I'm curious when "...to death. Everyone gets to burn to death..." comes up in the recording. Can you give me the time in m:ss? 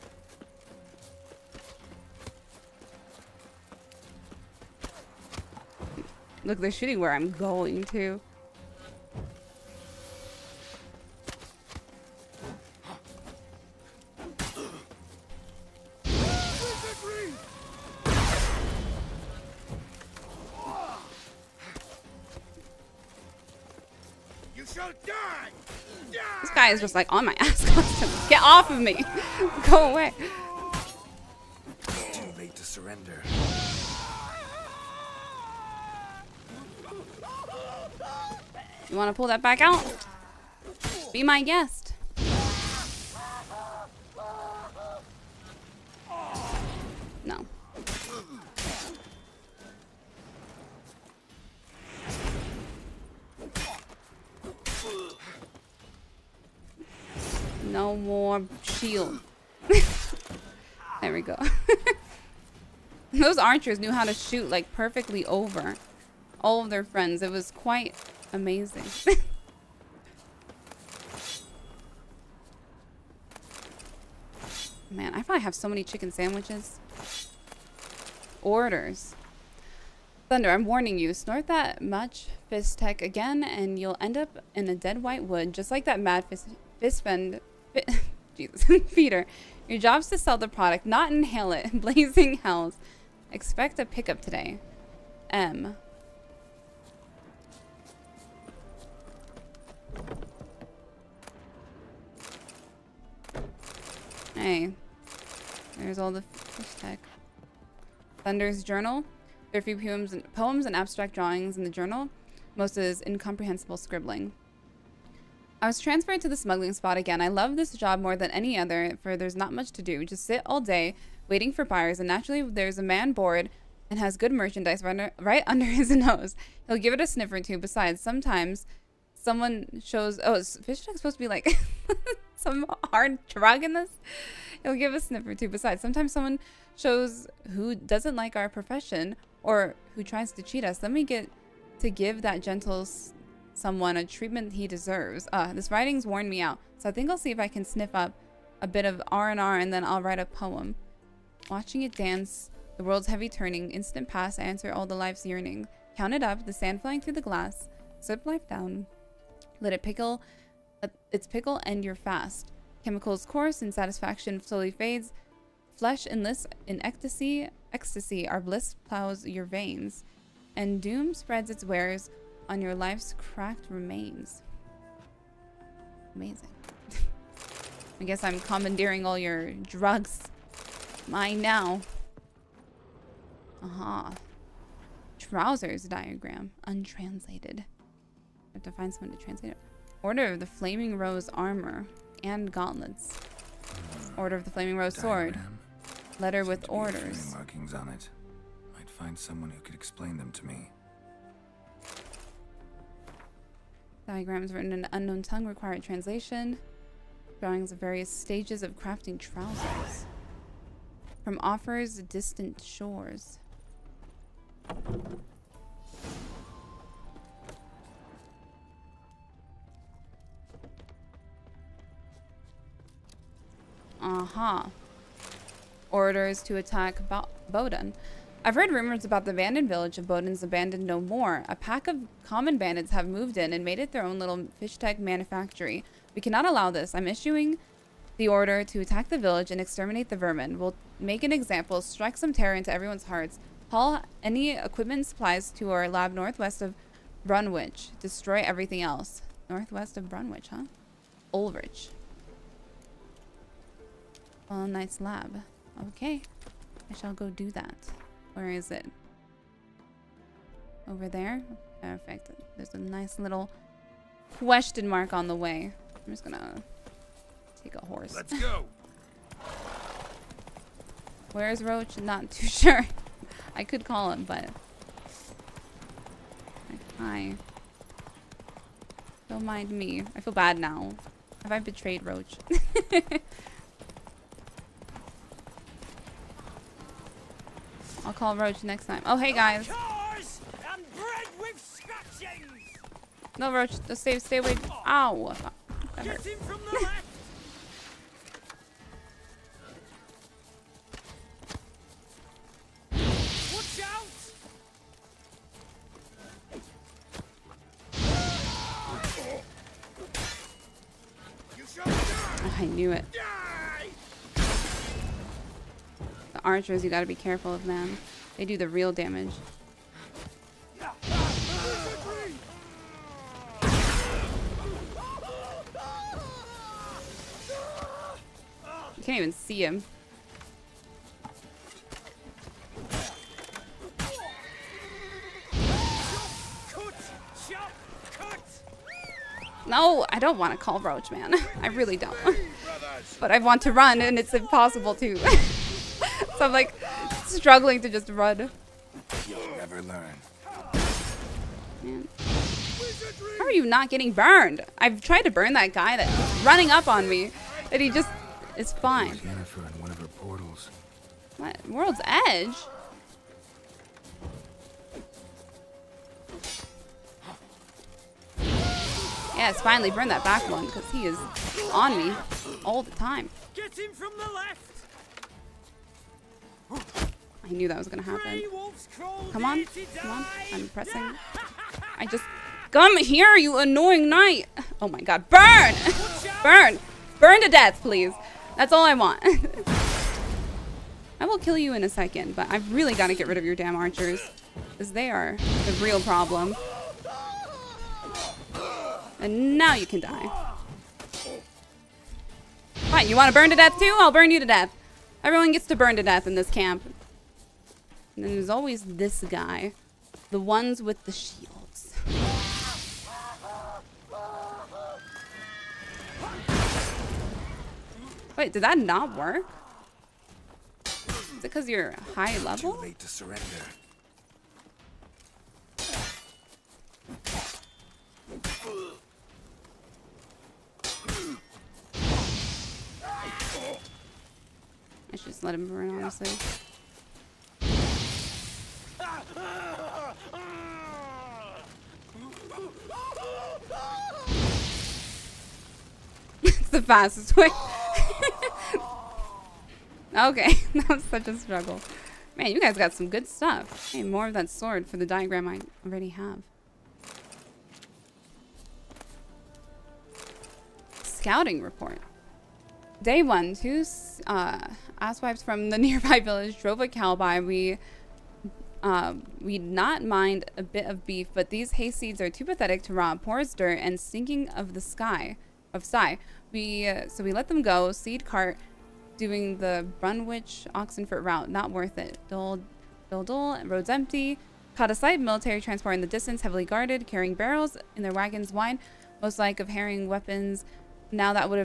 6:44.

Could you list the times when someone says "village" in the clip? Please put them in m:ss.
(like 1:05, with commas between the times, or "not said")
3:49, 3:59, 7:46.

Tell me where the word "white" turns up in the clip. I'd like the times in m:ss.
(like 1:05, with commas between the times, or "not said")
1:25.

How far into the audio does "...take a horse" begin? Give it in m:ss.
4:27.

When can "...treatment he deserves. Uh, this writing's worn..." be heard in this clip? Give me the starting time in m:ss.
2:24.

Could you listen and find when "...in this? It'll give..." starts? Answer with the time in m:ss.
2:13.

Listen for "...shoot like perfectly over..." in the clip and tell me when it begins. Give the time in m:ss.
1:04.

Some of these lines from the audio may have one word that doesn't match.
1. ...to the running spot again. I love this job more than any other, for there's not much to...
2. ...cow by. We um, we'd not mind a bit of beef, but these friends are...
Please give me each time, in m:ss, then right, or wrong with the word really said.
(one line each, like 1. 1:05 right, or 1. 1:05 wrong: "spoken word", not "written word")
1. 1:56 wrong: "smuggling", not "running"
2. 7:46 wrong: "hayseeds", not "friends".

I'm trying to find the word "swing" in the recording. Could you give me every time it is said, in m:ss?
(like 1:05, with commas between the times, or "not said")
not said.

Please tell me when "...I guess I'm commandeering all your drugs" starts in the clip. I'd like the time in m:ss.
2:58.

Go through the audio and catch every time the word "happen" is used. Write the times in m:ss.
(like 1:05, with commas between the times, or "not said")
6:18.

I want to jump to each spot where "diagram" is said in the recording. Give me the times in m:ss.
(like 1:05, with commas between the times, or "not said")
3:05, 3:24, 7:35.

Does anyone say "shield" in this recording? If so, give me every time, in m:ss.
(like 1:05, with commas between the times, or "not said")
0:58, 6:51.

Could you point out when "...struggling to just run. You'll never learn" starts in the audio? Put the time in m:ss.
5:47.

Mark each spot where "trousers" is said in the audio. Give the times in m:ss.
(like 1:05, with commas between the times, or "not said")
3:05, 3:29.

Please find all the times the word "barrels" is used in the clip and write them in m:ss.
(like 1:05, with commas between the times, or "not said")
8:07.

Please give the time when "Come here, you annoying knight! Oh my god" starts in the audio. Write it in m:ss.
6:22.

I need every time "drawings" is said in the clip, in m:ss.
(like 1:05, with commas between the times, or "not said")
1:51, 3:27.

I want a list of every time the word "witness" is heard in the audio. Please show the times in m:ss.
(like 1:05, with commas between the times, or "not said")
not said.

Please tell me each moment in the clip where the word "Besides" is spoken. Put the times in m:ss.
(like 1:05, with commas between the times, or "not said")
2:07, 2:15.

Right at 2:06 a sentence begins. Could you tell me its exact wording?
He'll give it a sniff or two.